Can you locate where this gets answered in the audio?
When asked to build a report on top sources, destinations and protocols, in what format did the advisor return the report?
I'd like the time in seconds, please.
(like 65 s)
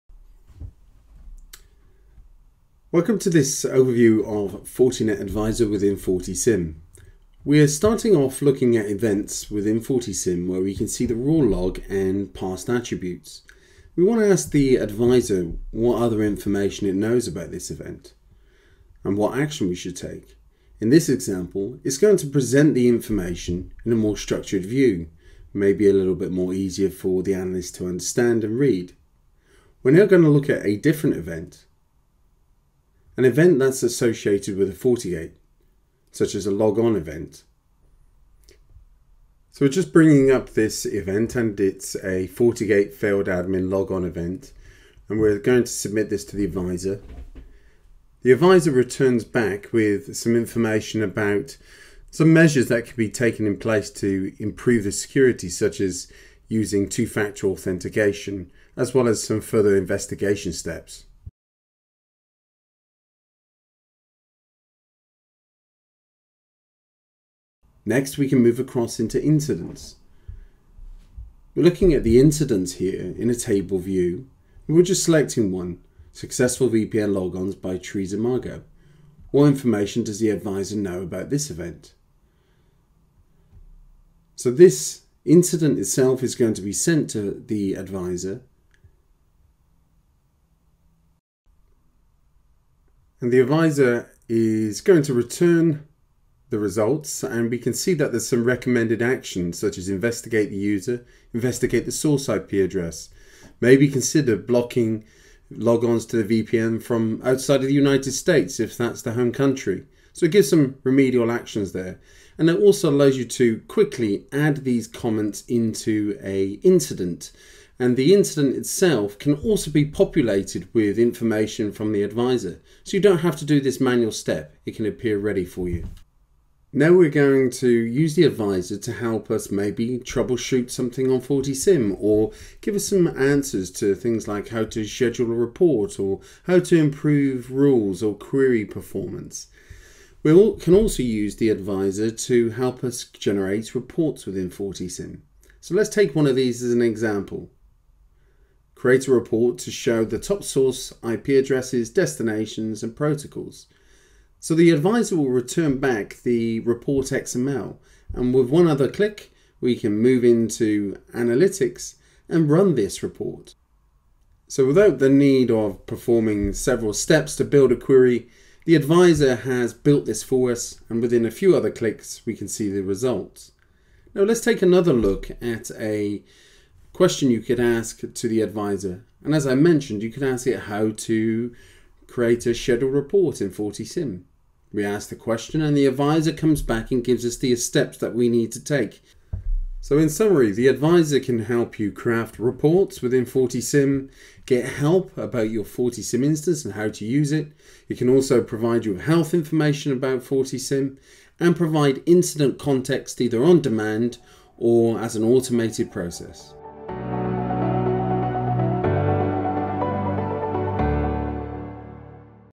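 157 s.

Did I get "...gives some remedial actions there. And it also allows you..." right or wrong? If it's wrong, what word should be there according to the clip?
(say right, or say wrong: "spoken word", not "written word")
right.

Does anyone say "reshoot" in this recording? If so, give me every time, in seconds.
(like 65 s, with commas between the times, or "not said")
not said.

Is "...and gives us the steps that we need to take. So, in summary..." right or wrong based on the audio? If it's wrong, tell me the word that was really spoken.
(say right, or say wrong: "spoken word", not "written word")
right.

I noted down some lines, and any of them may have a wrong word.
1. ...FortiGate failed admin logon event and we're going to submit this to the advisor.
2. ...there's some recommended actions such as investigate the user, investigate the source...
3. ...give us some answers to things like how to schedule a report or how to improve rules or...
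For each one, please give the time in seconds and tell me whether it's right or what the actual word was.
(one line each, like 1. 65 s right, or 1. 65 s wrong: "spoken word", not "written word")
1. 42 s right
2. 98 s right
3. 132 s right.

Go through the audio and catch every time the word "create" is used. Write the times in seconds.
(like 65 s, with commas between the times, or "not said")
148 s, 182 s.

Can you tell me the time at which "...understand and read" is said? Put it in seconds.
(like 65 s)
27 s.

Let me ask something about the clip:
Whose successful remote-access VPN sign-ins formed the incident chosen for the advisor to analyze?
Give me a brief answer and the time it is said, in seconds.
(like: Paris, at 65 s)
Teresa Margo, at 77 s.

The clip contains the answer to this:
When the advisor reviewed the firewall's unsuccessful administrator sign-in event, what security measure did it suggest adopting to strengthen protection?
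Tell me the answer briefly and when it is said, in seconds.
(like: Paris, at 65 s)
two-factor authentication, at 56 s.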